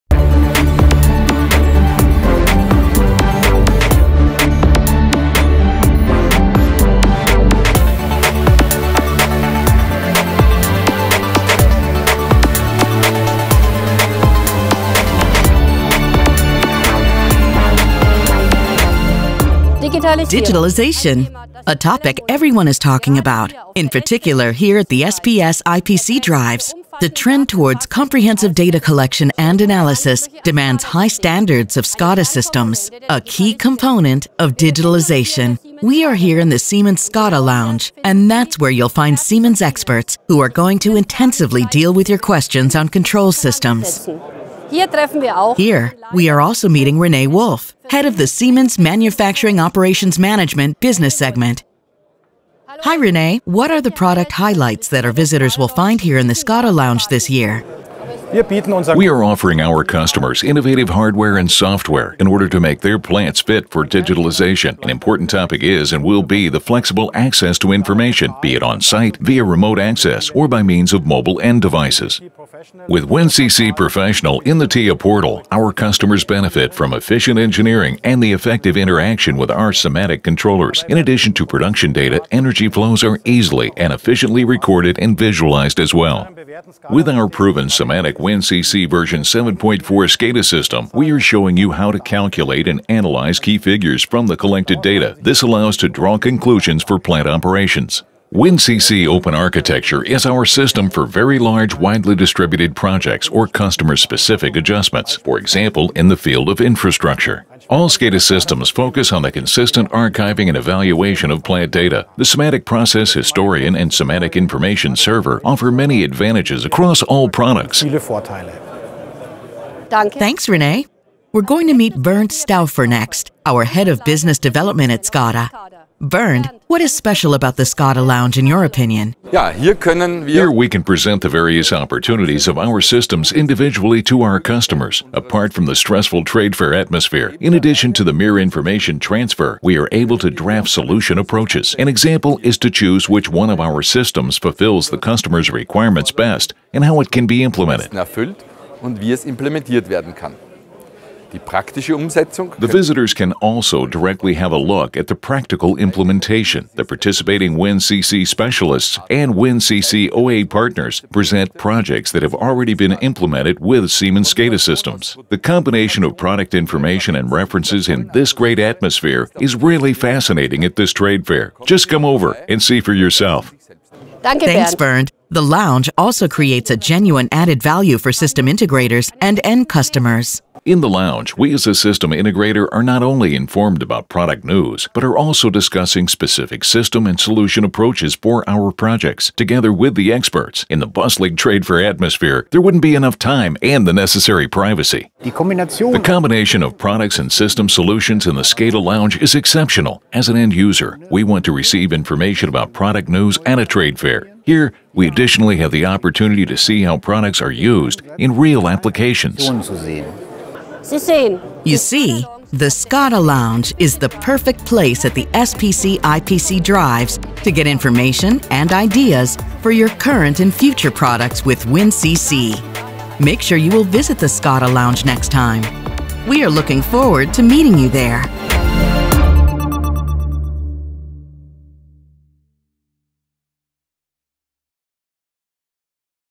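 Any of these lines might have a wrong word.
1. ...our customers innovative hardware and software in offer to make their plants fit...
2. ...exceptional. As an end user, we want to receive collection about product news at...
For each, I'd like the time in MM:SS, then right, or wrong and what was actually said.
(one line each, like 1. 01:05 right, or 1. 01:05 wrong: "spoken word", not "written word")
1. 00:59 wrong: "order", not "offer"
2. 03:19 wrong: "information", not "collection".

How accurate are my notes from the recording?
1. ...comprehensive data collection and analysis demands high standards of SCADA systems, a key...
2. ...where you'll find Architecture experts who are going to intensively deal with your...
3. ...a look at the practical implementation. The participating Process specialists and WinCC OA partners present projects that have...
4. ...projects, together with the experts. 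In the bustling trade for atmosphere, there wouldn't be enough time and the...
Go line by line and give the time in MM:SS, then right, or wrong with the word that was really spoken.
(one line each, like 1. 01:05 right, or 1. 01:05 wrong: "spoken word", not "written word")
1. 00:27 right
2. 00:38 wrong: "Siemens", not "Architecture"
3. 02:34 wrong: "WinCC", not "Process"
4. 03:08 right.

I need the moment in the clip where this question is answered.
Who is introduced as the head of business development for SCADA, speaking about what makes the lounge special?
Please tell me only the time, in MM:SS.
02:01.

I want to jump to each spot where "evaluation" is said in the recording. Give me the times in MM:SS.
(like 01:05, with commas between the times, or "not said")
01:50.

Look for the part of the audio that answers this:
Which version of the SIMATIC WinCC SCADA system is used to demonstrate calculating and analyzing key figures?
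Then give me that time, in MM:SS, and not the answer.
01:29.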